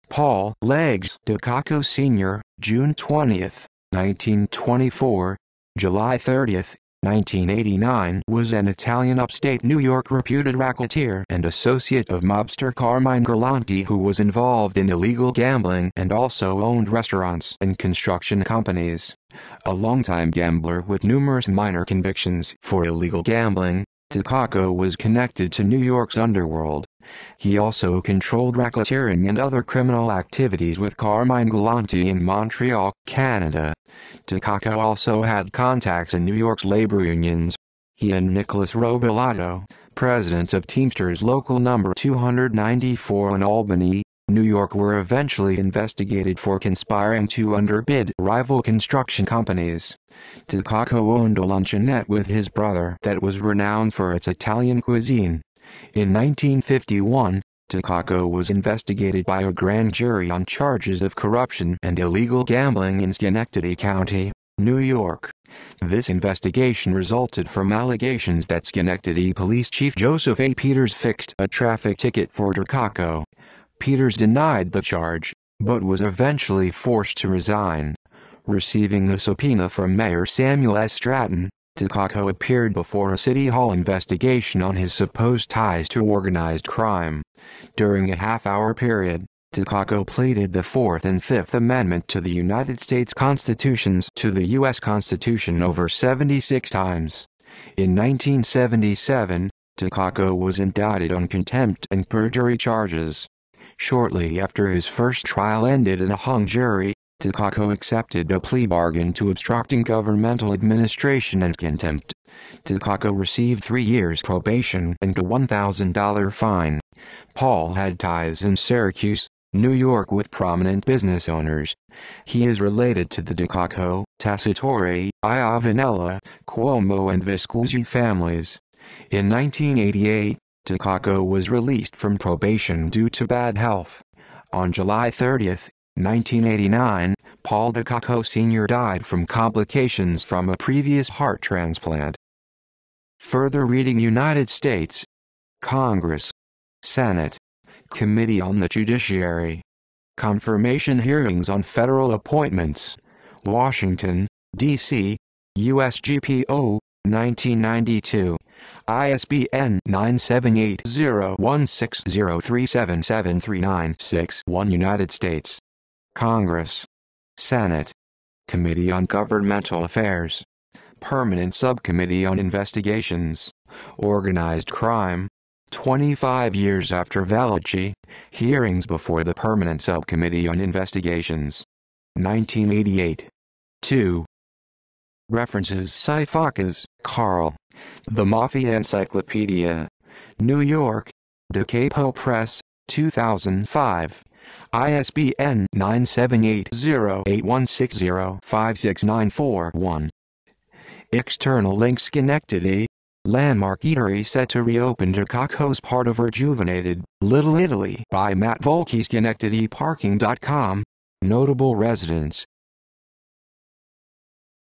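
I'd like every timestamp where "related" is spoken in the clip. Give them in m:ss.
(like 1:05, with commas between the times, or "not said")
2:02.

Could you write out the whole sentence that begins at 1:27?
During a half-hour period, DiCocco pleaded the Fourth and Fifth Amendment to the United States Constitutions to the U.S.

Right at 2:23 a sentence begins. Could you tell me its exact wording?
Further reading United States Congress Senate Committee on the Judiciary Confirmation Hearings on Federal Appointments Washington, D.C., USGPO, 1992.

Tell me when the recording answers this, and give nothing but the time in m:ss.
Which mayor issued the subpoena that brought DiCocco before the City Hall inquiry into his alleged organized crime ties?
1:20.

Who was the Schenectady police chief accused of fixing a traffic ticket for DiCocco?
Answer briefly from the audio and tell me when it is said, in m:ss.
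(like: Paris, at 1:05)
Joseph A. Peters, at 1:09.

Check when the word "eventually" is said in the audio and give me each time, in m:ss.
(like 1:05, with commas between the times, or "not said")
0:44, 1:16.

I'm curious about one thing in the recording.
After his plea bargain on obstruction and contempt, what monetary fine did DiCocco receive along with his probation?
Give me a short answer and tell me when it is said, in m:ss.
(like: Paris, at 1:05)
$1,000, at 1:55.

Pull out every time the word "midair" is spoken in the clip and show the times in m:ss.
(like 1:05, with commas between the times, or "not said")
not said.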